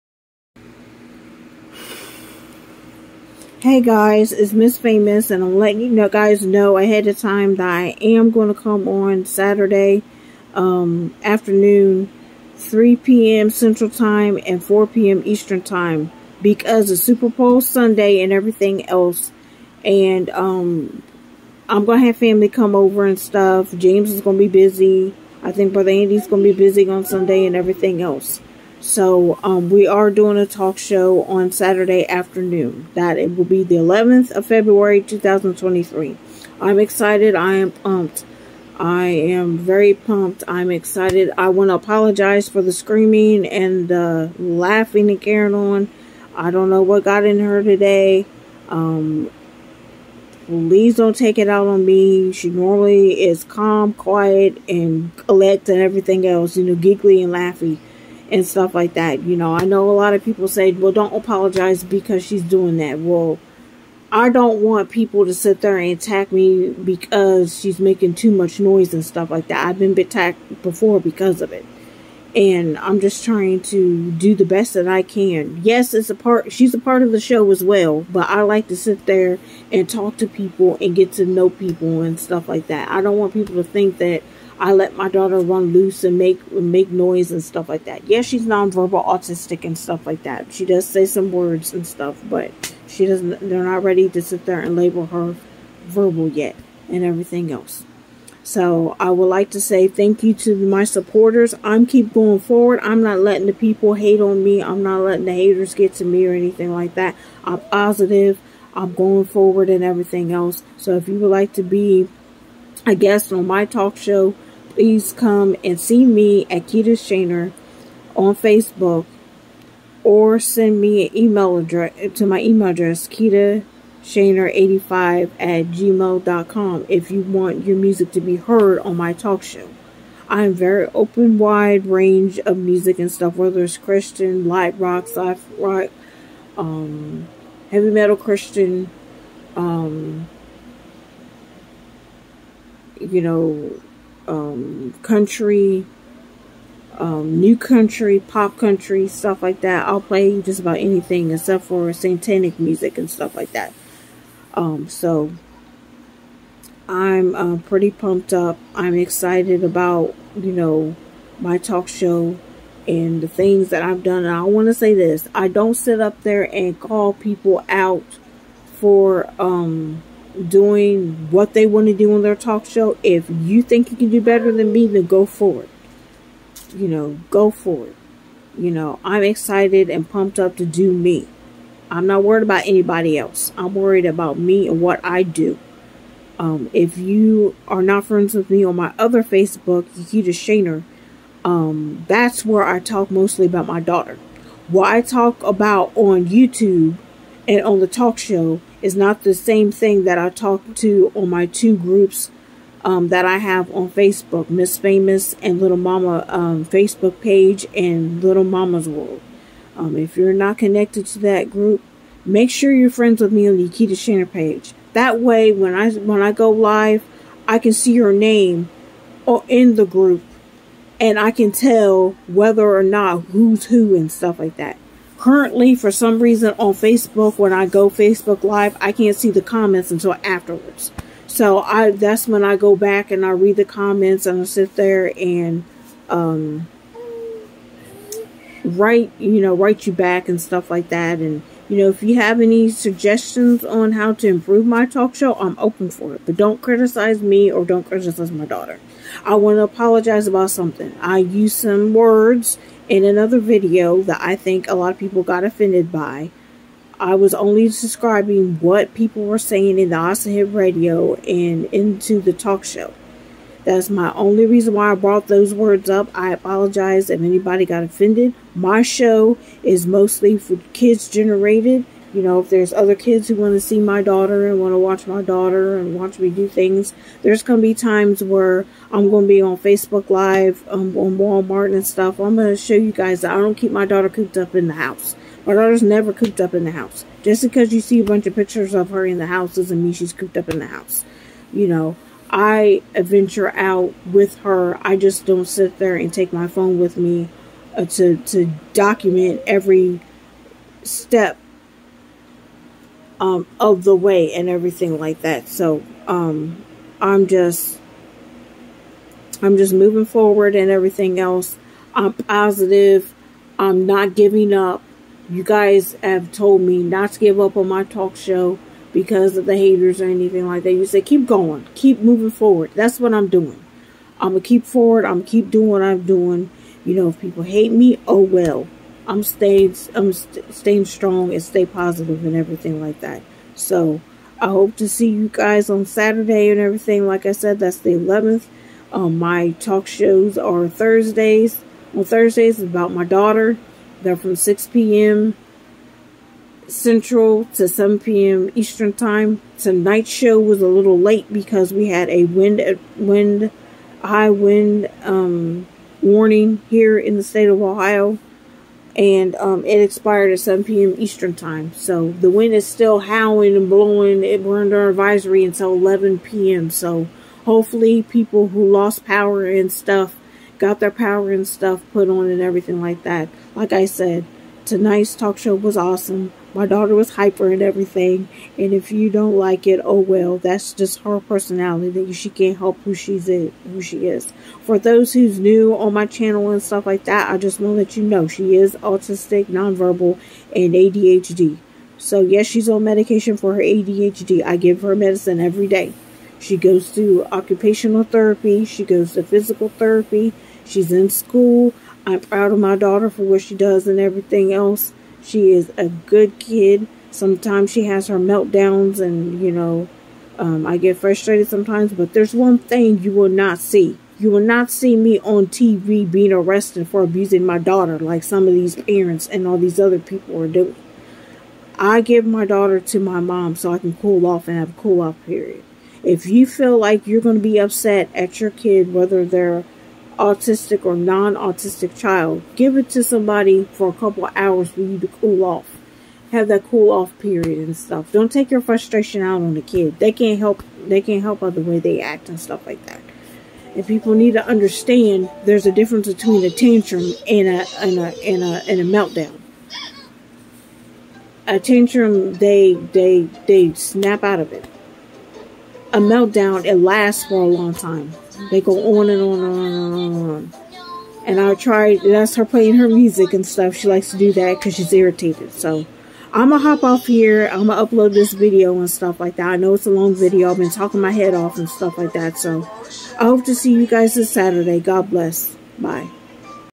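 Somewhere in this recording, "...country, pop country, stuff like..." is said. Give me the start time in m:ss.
2:27.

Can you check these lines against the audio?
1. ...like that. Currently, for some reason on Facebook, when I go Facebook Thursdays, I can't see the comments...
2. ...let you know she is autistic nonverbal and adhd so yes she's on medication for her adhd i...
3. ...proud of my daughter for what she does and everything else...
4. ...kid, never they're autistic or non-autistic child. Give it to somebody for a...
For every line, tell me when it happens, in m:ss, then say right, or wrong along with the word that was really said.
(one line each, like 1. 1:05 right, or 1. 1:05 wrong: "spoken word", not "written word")
1. 3:44 wrong: "Live", not "Thursdays"
2. 6:27 right
3. 6:42 right
4. 7:08 wrong: "whether", not "never".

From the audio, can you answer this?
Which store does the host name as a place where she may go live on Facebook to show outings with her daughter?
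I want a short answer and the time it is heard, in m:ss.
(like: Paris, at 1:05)
Walmart, at 4:41.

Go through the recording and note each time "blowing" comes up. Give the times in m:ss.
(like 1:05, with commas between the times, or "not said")
6:03.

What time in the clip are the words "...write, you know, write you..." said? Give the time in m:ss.
3:58.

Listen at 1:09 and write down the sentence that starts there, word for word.
I've been attacked before because of it.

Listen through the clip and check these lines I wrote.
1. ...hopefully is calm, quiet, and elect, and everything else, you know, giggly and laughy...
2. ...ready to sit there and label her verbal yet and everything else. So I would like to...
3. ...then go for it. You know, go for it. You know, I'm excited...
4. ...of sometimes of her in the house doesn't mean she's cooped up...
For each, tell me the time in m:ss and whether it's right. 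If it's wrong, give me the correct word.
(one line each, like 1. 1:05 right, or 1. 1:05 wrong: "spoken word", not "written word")
1. 0:52 wrong: "normally", not "hopefully"
2. 1:33 right
3. 2:54 right
4. 4:48 wrong: "pictures", not "sometimes".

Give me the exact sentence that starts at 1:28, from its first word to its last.
Yeah, she's nonverbal autistic and stuff like that.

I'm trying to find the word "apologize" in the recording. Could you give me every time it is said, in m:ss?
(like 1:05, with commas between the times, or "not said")
0:41, 1:01, 4:09, 4:26.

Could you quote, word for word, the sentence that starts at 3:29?
Um, if you're not connected to that group, make sure you're friends with me on the Nikita Shanner page.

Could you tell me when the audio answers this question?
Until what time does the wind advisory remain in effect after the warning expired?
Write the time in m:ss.
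6:05.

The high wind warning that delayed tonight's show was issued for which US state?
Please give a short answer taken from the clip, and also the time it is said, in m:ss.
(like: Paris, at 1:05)
Ohio, at 5:57.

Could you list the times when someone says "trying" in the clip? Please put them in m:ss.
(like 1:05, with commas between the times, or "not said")
1:13.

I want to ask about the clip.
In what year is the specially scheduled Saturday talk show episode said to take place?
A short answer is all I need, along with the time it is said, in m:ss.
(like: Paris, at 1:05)
2023, at 0:35.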